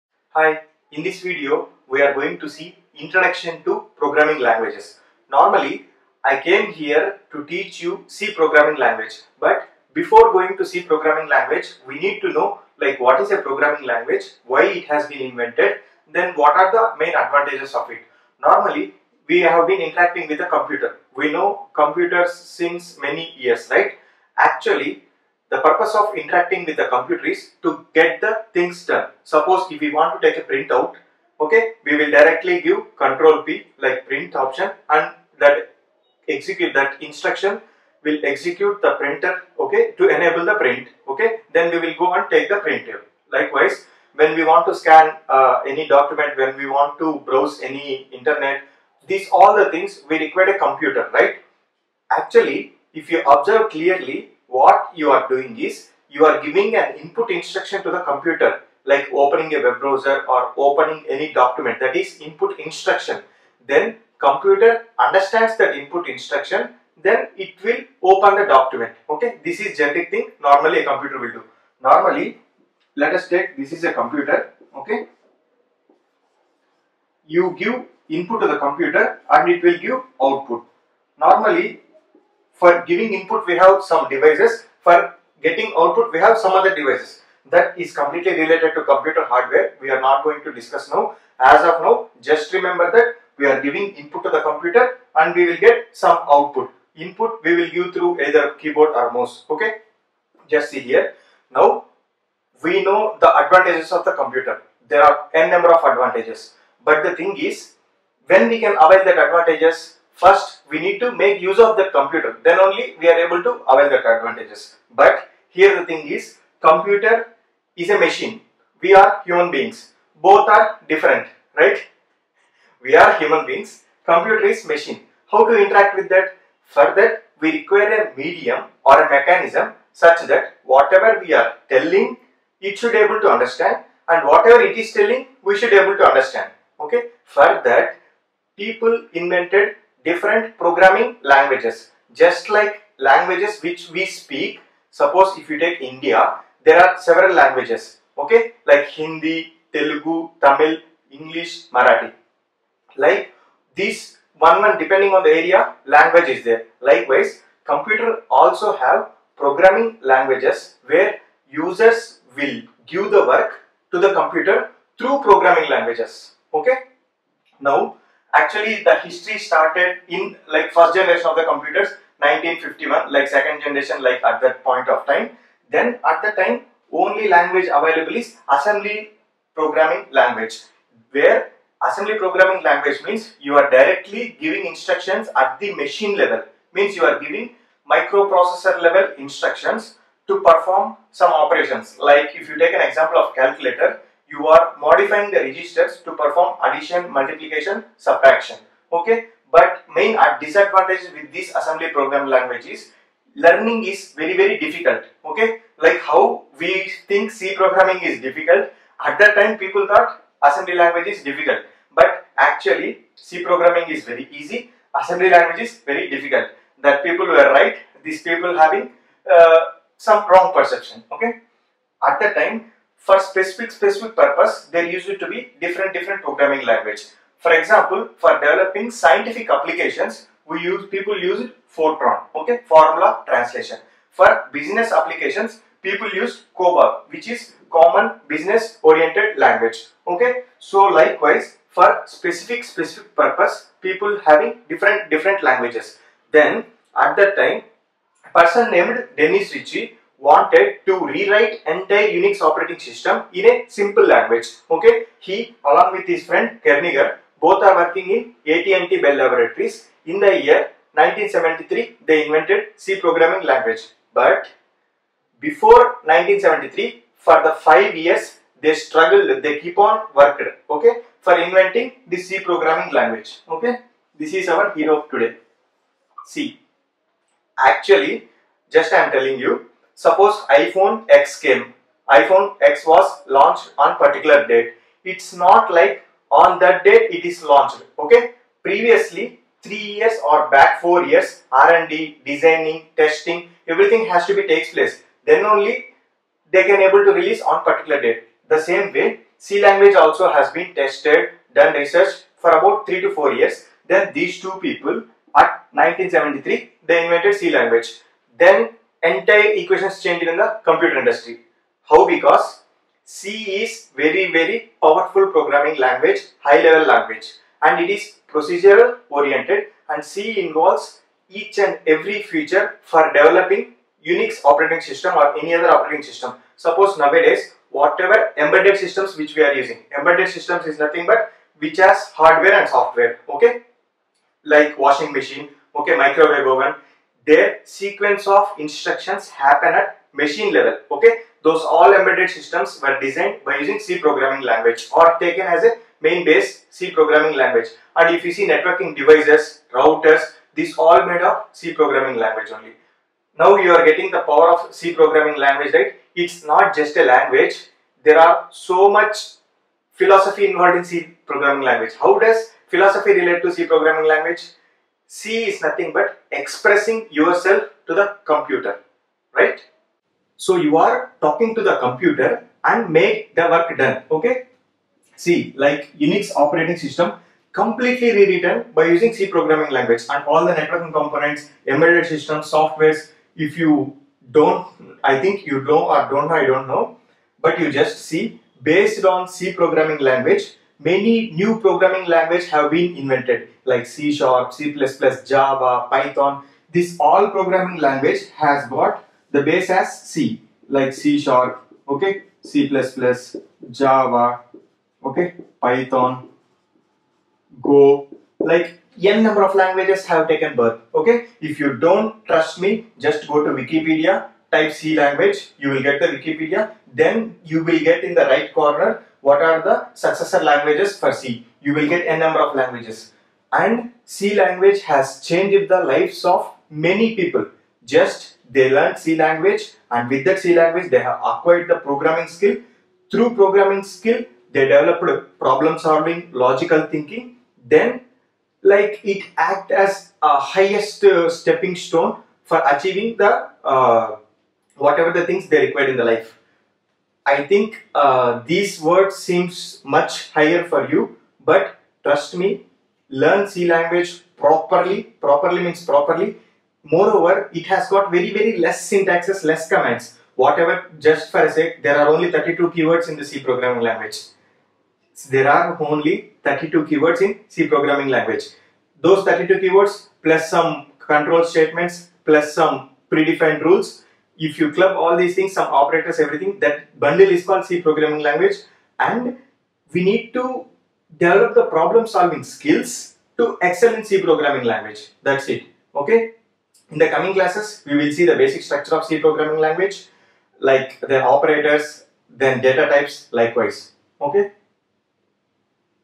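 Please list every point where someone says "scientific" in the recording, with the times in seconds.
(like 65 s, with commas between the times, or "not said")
228 s.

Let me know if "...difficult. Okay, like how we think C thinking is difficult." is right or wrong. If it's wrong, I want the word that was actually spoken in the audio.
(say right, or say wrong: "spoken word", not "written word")
wrong: "programming", not "thinking".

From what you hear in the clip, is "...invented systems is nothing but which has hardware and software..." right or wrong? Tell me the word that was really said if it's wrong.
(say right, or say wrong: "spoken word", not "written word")
wrong: "embedded", not "invented".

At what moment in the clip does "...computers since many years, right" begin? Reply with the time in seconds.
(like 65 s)
21 s.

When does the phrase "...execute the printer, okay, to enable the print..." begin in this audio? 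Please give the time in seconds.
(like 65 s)
38 s.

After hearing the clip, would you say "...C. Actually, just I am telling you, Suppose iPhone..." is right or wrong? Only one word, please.
right.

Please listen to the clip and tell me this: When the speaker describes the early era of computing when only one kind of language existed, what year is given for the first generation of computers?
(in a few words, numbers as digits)
1951.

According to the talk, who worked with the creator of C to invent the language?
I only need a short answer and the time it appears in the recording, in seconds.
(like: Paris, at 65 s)
Kernighan, at 256 s.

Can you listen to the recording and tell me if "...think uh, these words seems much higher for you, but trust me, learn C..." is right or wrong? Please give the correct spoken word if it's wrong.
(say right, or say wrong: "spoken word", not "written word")
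right.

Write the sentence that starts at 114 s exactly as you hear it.
But here the thing is, computer is a machine.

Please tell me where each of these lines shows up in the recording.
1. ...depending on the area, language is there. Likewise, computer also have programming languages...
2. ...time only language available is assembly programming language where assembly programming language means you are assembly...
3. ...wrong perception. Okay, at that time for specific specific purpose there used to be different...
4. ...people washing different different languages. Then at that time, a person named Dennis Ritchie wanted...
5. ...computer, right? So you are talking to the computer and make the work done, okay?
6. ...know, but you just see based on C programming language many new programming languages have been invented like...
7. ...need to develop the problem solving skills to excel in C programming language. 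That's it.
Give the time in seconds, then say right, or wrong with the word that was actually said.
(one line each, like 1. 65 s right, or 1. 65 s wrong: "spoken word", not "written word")
1. 154 s right
2. 176 s wrong: "directly", not "assembly"
3. 220 s right
4. 243 s wrong: "having", not "washing"
5. 368 s right
6. 386 s right
7. 480 s right.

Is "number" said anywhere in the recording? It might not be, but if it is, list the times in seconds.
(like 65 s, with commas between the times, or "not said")
105 s, 409 s, 422 s.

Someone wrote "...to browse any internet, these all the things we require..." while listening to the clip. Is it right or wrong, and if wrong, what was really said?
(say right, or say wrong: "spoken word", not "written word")
right.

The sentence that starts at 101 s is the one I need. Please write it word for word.
Now we know the advantages of the computer.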